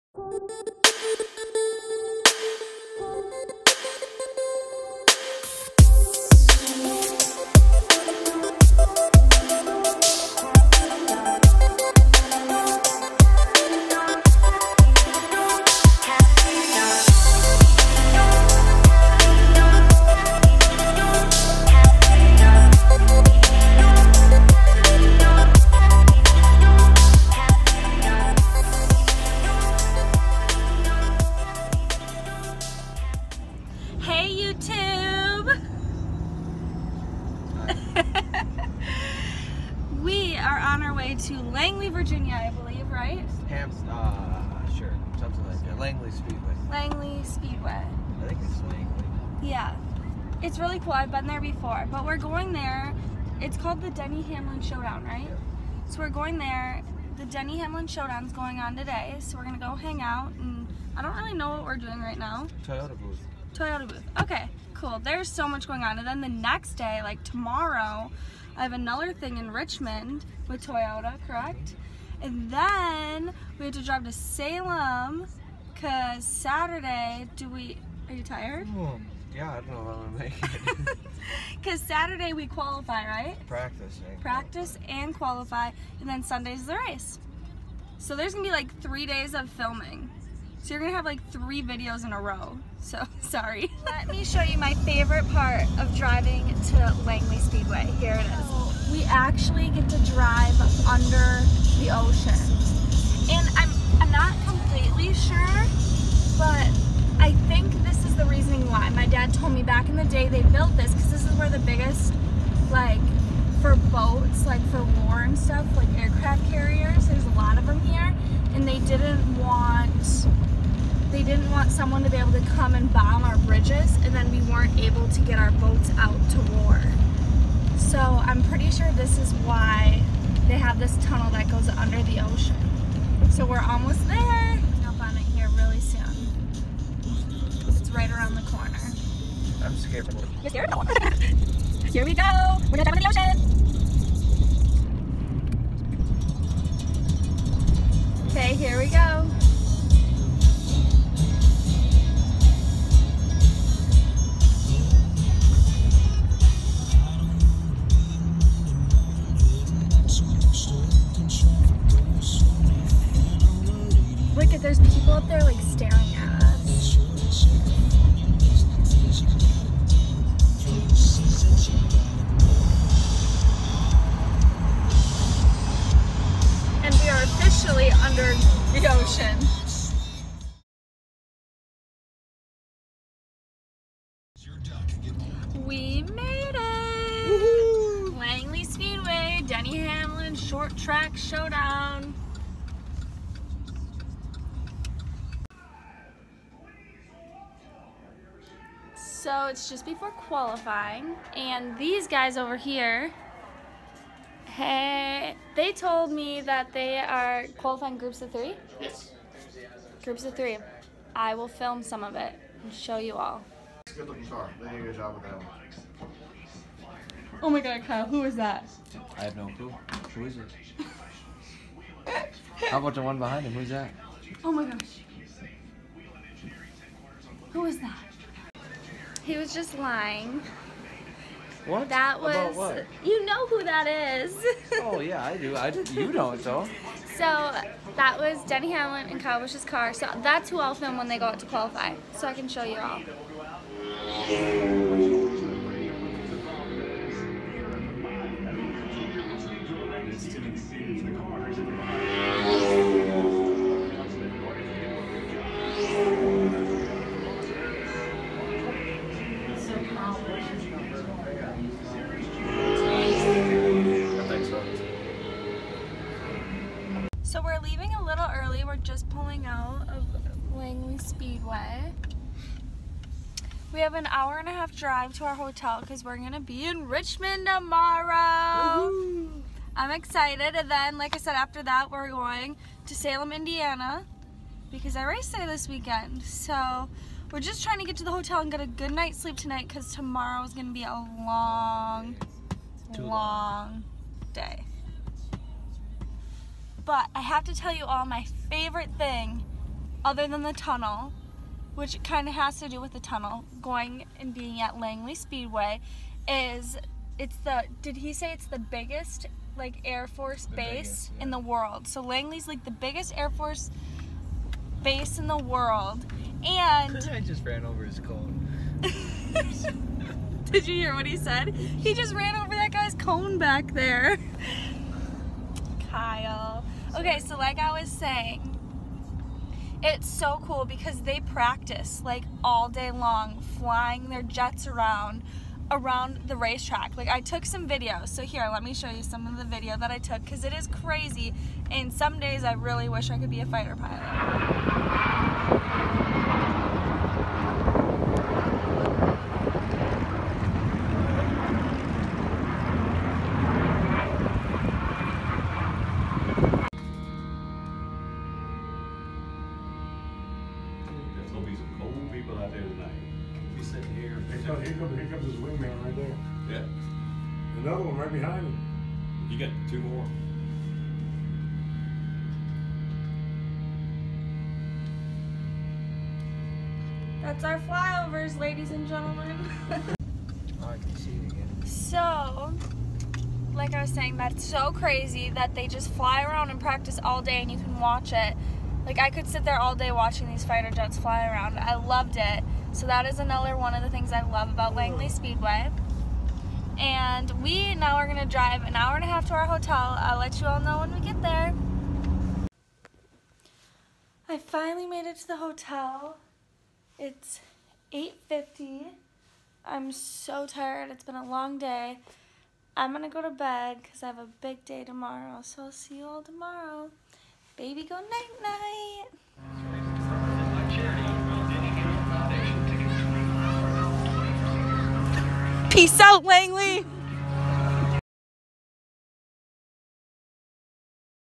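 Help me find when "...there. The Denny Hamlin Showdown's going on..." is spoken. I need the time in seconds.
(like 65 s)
56 s.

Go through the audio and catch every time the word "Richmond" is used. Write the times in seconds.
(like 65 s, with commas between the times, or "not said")
69 s, 276 s.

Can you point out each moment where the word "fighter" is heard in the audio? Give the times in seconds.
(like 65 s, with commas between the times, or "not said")
343 s, 390 s.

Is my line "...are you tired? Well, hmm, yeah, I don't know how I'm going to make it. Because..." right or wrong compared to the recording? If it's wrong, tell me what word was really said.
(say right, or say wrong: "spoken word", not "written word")
right.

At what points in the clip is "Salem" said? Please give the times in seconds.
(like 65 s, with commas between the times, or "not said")
74 s, 282 s.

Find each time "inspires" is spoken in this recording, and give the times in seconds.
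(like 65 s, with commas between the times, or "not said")
not said.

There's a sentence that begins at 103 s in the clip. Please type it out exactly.
And I'm, I'm not completely sure, but I think this is the reasoning why.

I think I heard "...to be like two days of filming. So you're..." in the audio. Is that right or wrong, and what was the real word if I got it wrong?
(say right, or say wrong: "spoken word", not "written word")
wrong: "three", not "two".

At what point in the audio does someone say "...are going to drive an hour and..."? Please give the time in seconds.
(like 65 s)
397 s.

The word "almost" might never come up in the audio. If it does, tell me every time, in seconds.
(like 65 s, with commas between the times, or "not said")
133 s.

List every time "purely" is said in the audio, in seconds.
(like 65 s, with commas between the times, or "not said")
not said.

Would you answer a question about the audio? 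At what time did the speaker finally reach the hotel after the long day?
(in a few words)
8:50.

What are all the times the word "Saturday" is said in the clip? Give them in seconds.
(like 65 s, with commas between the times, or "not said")
76 s, 81 s.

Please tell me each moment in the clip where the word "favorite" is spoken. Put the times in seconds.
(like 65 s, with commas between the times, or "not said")
94 s, 298 s.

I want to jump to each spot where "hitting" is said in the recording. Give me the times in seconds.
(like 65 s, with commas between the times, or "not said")
not said.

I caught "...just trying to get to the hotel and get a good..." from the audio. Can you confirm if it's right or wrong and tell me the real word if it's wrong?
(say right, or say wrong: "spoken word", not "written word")
right.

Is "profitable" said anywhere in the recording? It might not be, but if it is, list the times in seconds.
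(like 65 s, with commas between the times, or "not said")
not said.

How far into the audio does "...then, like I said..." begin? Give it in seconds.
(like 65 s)
280 s.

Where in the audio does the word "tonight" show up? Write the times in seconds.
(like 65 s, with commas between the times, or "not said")
289 s.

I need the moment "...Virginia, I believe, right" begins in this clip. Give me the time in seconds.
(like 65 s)
41 s.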